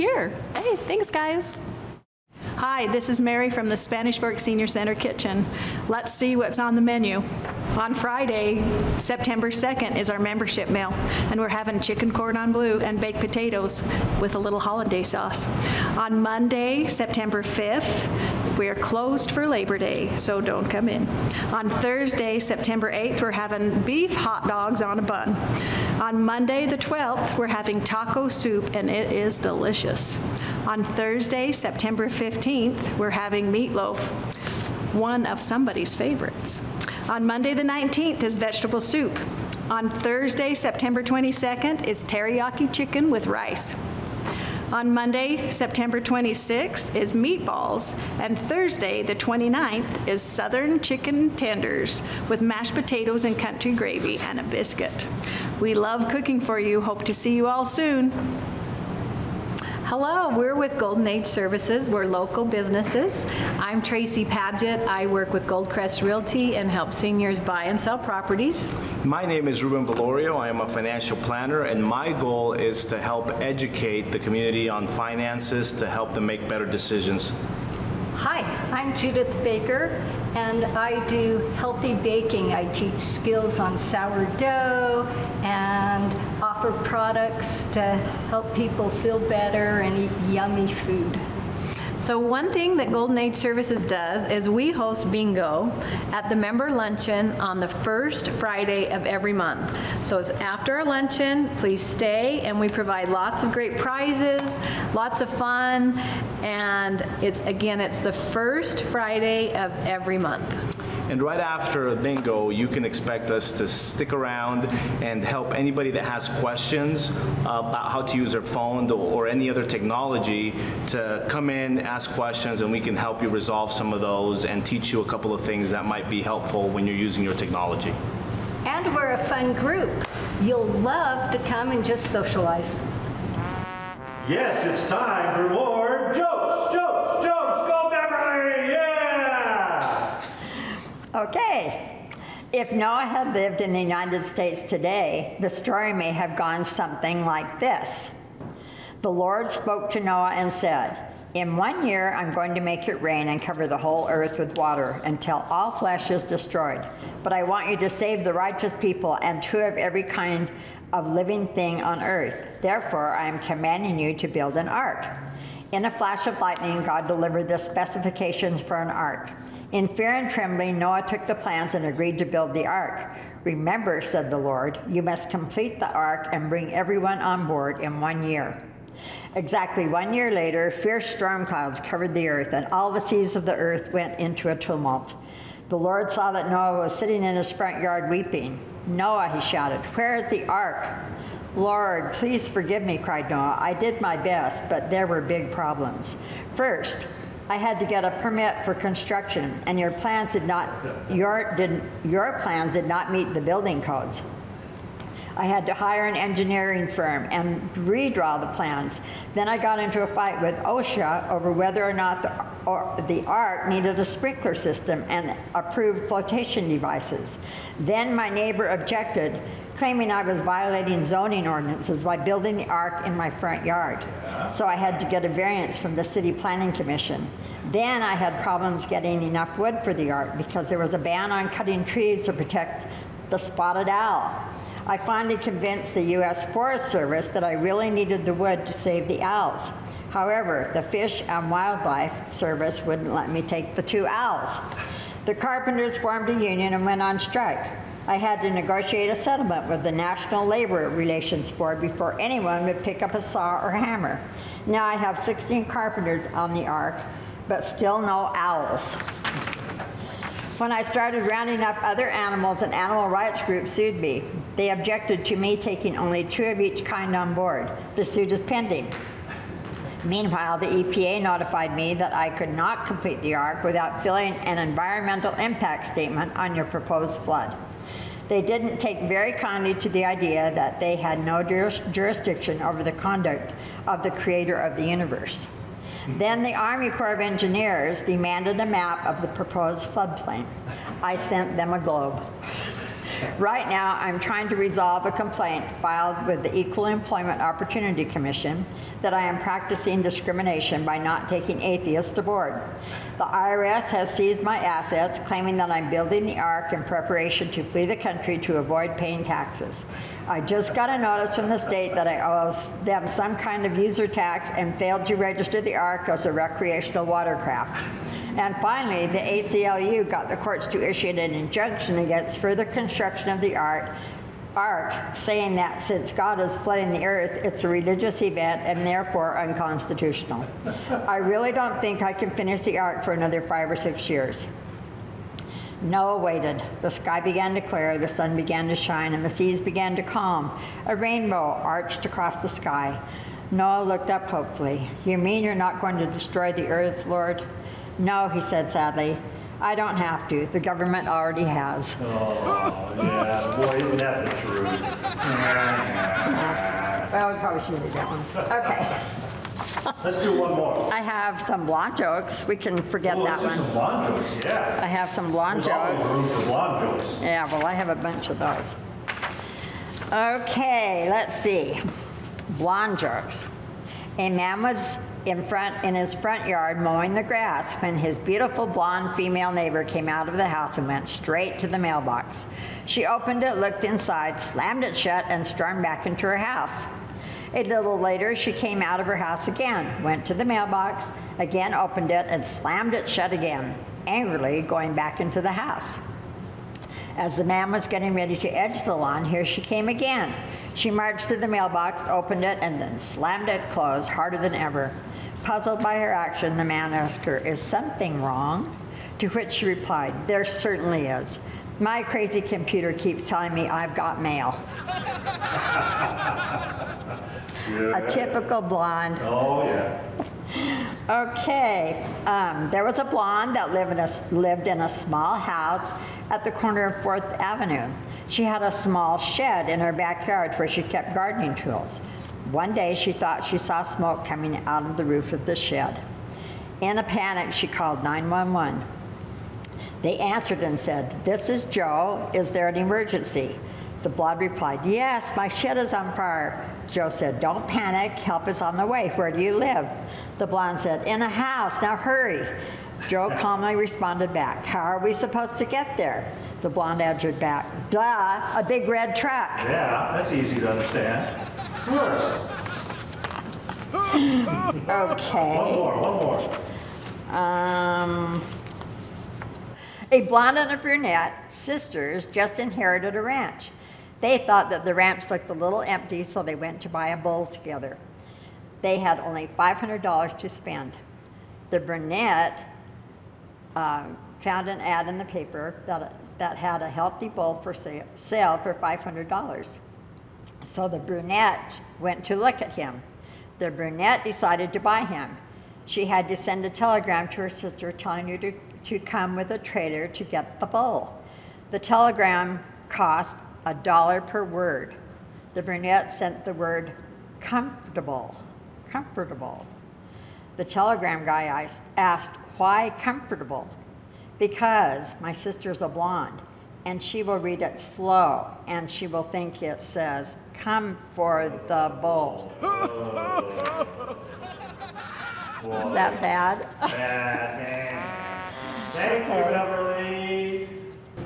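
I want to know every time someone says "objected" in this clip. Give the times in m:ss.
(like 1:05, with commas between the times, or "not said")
3:38, 4:24.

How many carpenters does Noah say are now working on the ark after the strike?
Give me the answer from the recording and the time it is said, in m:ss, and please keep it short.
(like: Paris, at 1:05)
16, at 4:15.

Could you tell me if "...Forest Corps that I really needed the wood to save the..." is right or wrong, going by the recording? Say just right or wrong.
wrong.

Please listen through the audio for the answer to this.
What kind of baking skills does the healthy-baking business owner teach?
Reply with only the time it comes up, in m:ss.
1:23.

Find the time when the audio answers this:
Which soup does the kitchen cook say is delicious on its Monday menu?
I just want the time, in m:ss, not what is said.
0:27.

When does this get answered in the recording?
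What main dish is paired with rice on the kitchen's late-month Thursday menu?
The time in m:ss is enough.
0:42.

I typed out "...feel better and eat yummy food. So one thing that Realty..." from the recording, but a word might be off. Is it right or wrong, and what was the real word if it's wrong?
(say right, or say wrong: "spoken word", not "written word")
wrong: "Golden", not "Realty".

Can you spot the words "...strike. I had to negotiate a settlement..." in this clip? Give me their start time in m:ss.
4:07.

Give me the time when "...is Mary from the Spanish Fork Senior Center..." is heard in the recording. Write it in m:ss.
0:03.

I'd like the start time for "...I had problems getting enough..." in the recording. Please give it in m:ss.
3:48.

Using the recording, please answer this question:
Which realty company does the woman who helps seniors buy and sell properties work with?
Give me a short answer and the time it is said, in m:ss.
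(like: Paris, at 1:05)
Goldcrest Realty, at 1:05.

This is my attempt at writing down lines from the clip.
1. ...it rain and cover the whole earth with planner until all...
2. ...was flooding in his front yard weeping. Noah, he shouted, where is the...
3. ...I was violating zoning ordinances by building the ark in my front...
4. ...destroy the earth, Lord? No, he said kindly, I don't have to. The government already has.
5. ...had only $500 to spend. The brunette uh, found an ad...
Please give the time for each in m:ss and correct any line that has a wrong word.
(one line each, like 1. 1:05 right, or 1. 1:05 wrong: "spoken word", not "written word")
1. 2:32 wrong: "water", not "planner"
2. 3:06 wrong: "sitting", not "flooding"
3. 3:40 right
4. 5:46 wrong: "sadly", not "kindly"
5. 7:58 right.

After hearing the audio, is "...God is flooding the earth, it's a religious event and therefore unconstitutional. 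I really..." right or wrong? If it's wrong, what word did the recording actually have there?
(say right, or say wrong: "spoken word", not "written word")
right.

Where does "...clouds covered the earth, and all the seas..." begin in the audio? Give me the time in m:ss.
3:01.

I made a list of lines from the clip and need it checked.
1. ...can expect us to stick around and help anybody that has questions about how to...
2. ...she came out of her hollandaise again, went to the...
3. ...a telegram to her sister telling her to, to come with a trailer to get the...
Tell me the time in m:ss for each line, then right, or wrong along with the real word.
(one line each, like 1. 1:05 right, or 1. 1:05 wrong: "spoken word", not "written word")
1. 1:52 right
2. 6:28 wrong: "house", not "hollandaise"
3. 8:16 right.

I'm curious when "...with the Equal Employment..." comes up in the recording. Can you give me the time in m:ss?
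4:56.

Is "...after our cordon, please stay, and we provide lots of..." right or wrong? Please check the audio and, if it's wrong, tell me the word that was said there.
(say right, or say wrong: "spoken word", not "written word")
wrong: "luncheon", not "cordon".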